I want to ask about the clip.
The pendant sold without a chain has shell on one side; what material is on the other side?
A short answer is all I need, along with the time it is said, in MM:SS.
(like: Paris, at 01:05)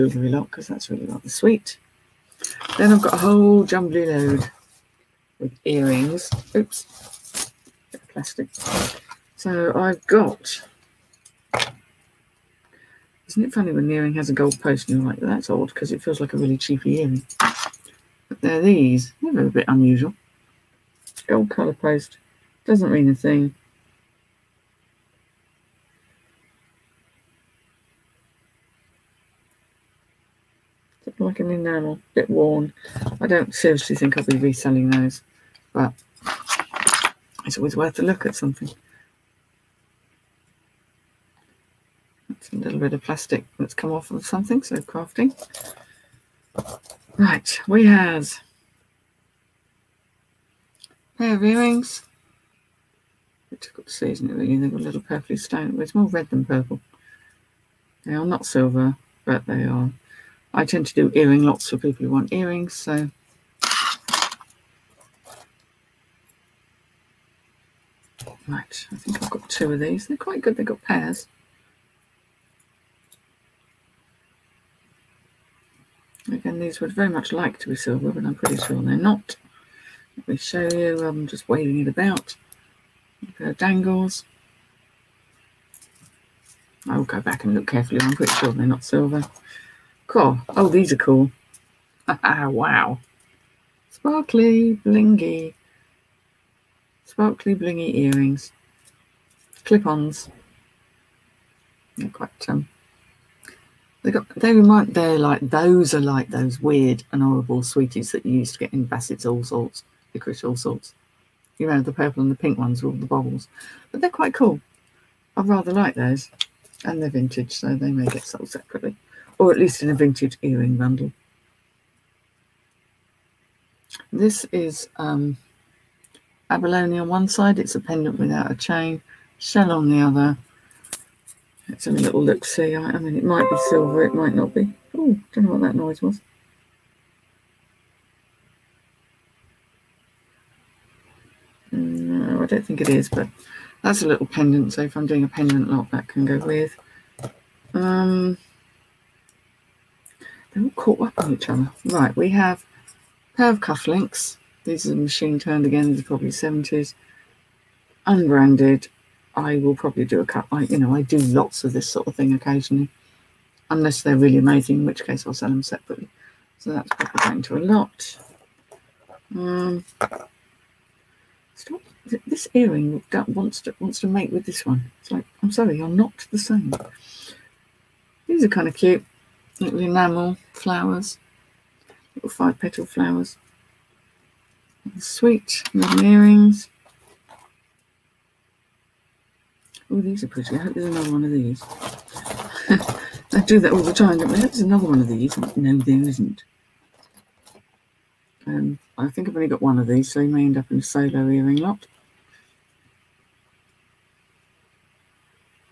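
Abalone, at 02:06.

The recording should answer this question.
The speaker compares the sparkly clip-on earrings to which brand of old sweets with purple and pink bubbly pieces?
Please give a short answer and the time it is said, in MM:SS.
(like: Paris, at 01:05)
Bassett's Allsorts, at 01:48.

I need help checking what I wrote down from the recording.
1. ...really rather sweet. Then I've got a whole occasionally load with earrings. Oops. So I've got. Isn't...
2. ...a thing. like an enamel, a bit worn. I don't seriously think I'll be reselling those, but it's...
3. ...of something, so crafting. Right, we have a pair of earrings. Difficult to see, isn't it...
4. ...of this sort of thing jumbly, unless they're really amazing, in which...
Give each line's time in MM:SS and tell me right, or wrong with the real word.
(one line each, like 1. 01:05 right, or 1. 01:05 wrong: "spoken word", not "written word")
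1. 00:00 wrong: "jumbly", not "occasionally"
2. 00:23 right
3. 00:44 right
4. 02:41 wrong: "occasionally", not "jumbly".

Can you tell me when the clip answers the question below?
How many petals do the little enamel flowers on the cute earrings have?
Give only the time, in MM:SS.
03:02.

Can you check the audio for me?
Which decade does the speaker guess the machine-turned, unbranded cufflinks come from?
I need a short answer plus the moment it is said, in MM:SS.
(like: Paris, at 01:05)
70s, at 02:36.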